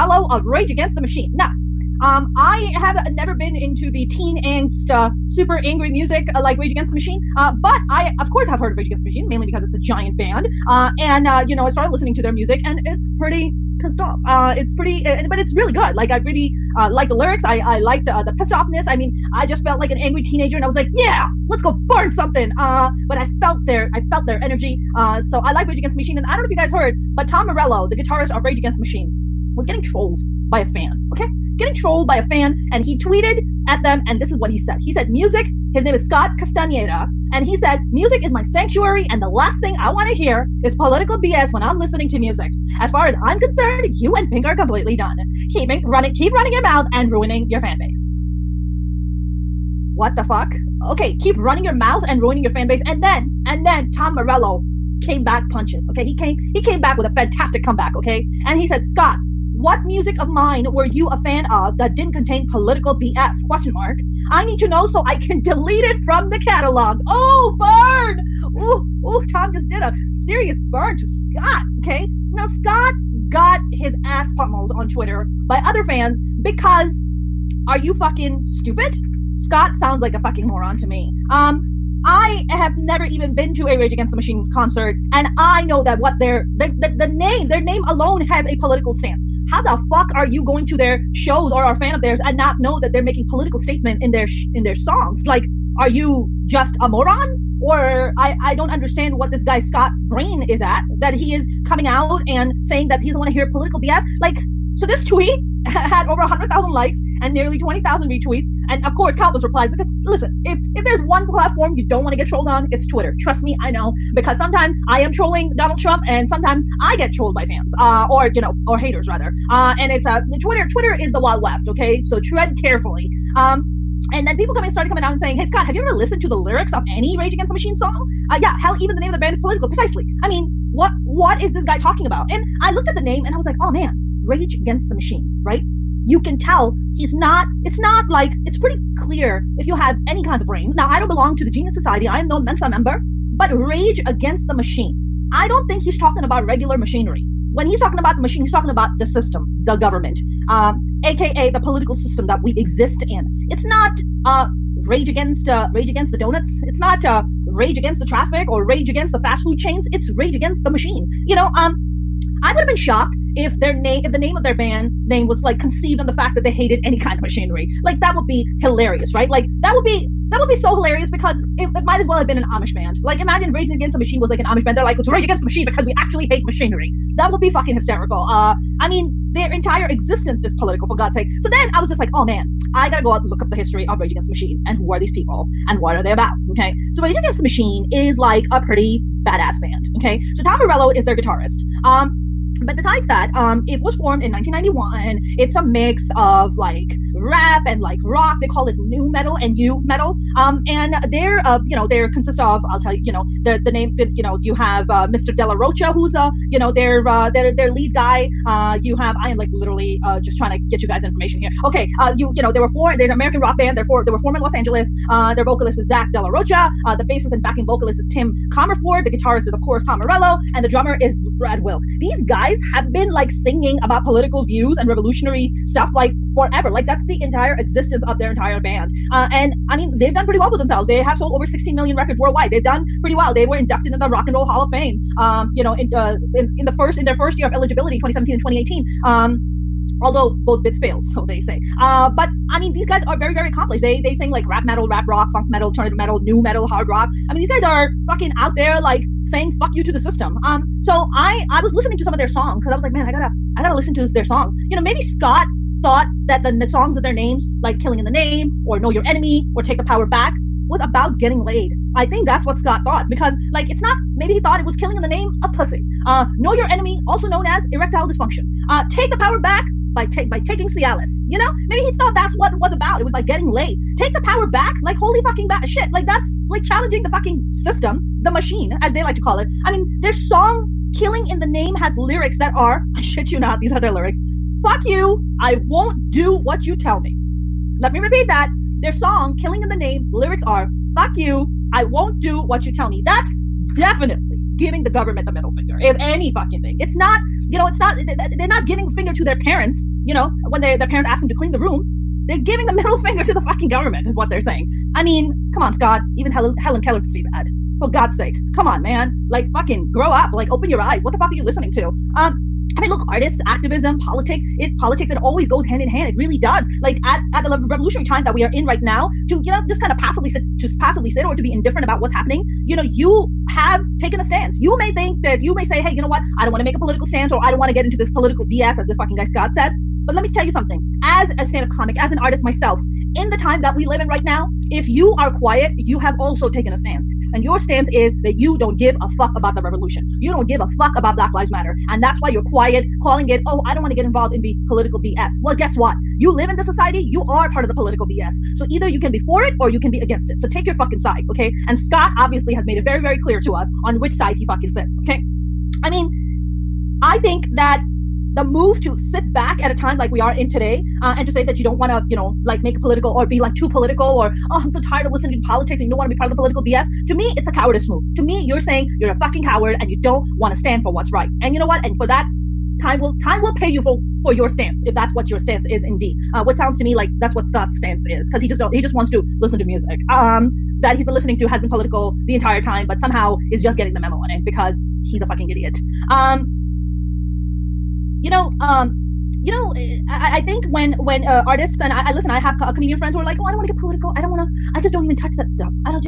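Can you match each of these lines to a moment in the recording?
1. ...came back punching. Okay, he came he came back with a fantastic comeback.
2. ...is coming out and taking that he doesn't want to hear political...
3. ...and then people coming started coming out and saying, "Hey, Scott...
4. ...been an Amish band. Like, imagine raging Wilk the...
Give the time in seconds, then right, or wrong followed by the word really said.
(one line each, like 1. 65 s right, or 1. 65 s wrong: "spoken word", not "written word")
1. 55 s right
2. 101 s wrong: "saying", not "taking"
3. 124 s right
4. 172 s wrong: "Against", not "Wilk".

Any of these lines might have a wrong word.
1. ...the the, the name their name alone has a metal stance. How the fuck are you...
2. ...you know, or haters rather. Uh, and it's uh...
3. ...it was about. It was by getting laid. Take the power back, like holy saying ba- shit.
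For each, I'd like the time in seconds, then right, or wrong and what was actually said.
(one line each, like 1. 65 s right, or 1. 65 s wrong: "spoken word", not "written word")
1. 86 s wrong: "political", not "metal"
2. 118 s right
3. 272 s wrong: "fucking", not "saying".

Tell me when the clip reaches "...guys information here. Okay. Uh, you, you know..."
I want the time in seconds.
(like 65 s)
210 s.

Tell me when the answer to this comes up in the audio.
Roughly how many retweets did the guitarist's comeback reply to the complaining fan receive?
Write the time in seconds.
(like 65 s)
107 s.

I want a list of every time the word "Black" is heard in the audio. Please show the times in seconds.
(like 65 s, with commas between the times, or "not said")
341 s.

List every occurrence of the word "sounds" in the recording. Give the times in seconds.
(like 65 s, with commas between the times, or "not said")
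79 s, 376 s.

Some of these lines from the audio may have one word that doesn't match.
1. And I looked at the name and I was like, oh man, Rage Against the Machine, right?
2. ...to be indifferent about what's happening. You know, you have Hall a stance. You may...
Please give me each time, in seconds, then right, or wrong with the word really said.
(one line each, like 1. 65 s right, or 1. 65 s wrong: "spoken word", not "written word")
1. 132 s right
2. 321 s wrong: "Taking", not "Hall".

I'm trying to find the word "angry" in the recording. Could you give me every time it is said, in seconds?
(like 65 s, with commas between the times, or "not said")
5 s, 19 s.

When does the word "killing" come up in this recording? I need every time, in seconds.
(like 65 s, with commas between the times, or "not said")
257 s, 264 s, 280 s, 289 s.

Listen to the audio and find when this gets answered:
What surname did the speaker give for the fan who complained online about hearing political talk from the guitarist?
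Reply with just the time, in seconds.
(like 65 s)
36 s.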